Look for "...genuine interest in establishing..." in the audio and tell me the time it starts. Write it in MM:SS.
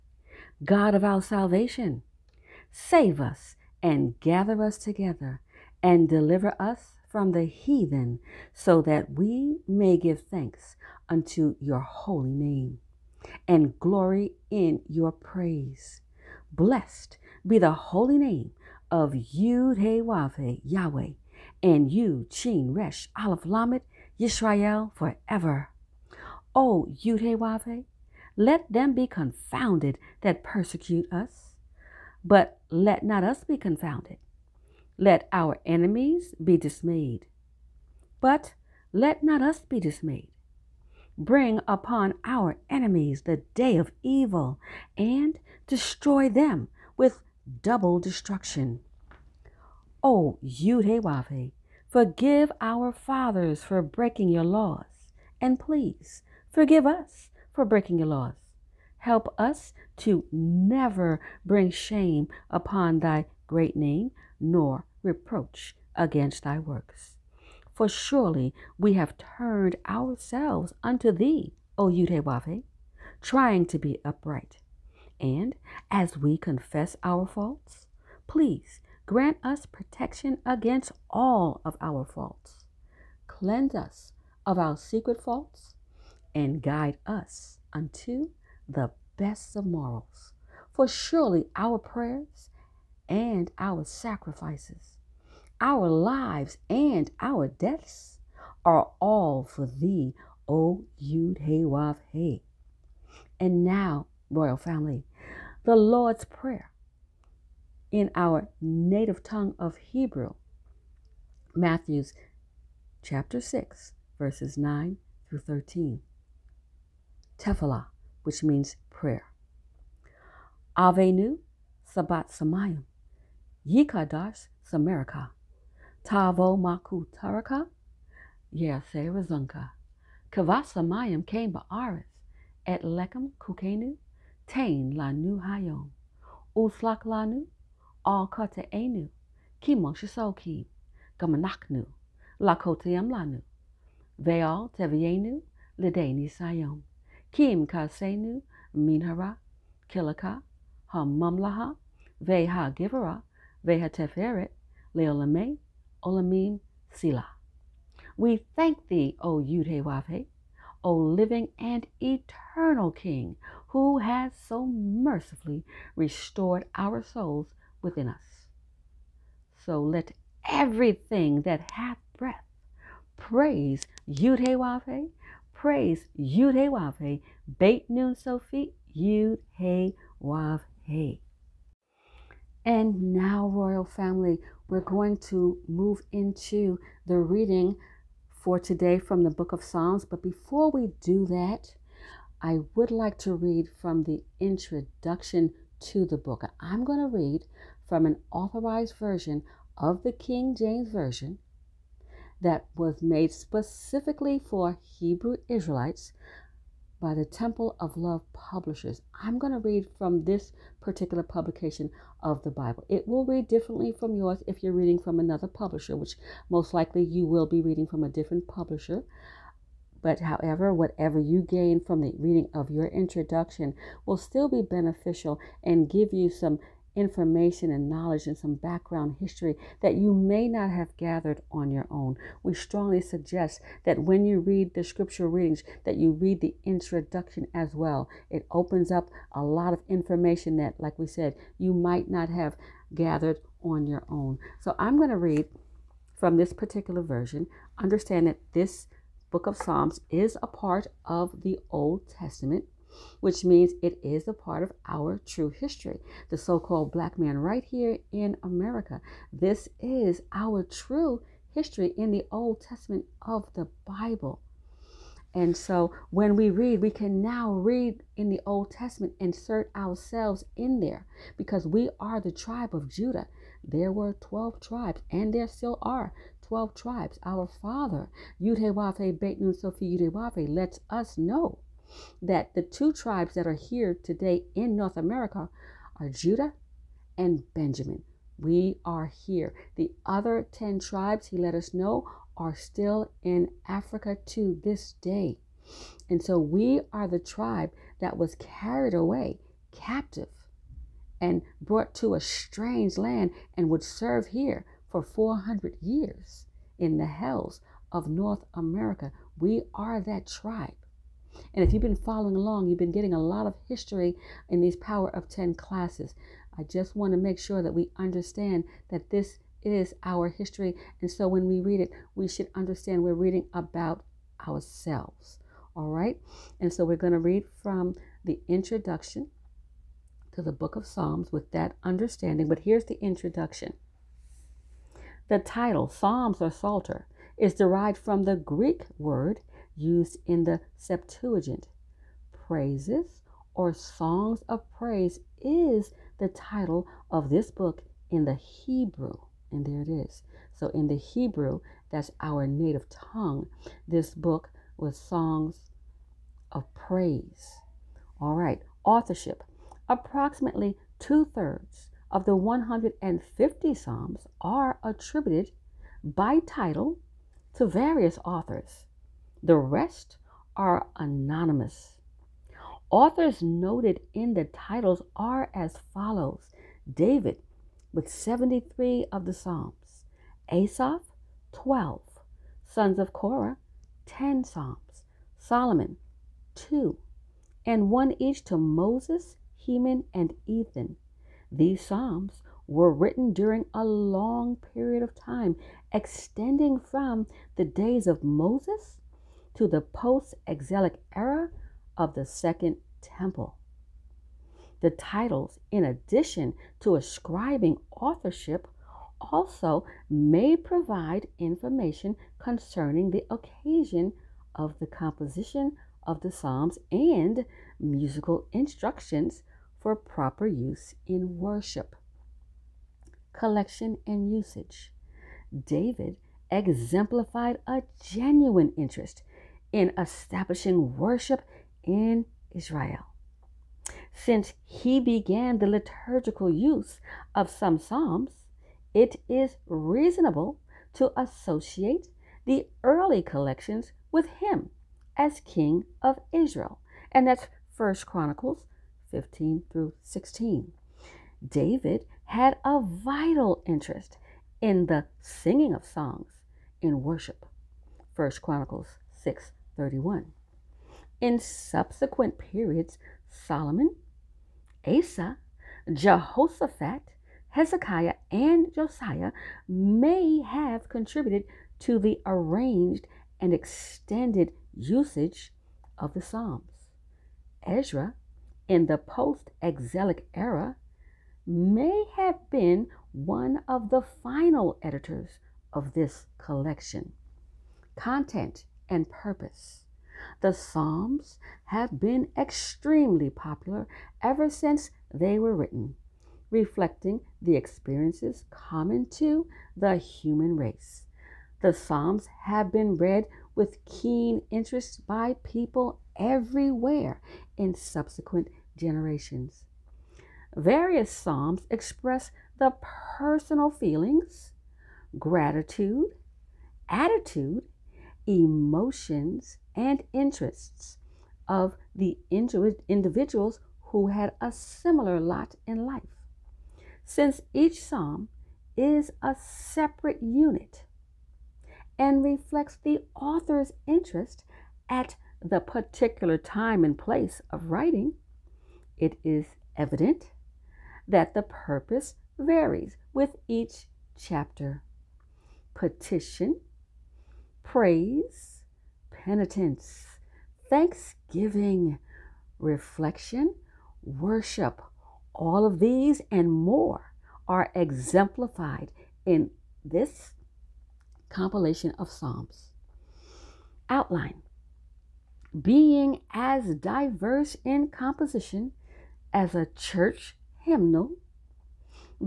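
07:08.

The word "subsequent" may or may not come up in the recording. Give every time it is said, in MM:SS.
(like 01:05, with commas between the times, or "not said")
07:41, 08:27.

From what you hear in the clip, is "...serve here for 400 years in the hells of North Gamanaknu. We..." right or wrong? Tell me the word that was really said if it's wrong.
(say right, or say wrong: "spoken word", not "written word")
wrong: "America", not "Gamanaknu".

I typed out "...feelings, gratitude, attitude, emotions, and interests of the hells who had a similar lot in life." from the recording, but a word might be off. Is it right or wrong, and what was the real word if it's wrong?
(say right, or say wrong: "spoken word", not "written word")
wrong: "individuals", not "hells".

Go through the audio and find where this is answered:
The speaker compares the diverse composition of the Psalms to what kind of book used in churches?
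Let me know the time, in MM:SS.
09:29.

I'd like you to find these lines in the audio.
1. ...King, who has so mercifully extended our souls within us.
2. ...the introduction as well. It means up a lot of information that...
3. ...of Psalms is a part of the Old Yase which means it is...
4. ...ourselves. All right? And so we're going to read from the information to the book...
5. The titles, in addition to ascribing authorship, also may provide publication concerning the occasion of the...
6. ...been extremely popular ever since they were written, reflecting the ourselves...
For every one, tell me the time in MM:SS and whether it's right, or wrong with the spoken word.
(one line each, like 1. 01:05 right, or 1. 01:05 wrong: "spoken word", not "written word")
1. 02:42 wrong: "restored", not "extended"
2. 03:56 wrong: "opens", not "means"
3. 04:09 wrong: "Testament", not "Yase"
4. 05:24 wrong: "introduction", not "information"
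5. 06:44 wrong: "information", not "publication"
6. 08:11 wrong: "experiences", not "ourselves".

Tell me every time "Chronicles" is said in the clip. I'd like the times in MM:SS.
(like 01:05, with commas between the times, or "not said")
07:28, 07:38.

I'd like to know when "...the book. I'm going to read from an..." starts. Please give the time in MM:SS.
03:16.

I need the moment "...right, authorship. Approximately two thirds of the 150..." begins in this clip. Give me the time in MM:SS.
05:58.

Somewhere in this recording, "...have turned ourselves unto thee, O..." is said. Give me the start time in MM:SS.
01:08.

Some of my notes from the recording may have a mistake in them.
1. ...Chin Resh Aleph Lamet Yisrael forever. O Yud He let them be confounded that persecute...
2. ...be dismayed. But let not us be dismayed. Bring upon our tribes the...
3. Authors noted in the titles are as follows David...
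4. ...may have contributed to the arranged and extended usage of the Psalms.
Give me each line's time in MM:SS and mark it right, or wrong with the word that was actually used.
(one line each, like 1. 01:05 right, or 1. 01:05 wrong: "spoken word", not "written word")
1. 00:22 right
2. 00:36 wrong: "enemies", not "tribes"
3. 06:12 right
4. 07:49 right.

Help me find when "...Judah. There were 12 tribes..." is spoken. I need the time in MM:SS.
04:32.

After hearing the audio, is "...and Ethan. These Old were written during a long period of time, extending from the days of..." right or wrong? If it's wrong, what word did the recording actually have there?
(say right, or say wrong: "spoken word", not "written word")
wrong: "Psalms", not "Old".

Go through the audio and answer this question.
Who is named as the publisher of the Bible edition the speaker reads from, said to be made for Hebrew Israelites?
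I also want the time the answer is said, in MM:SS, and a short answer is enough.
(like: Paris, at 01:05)
Temple of Love, at 03:27.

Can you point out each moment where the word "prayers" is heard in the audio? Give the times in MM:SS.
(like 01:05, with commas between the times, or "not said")
01:31, 01:46, 01:58.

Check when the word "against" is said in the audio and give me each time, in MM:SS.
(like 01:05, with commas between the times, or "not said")
01:05, 01:20.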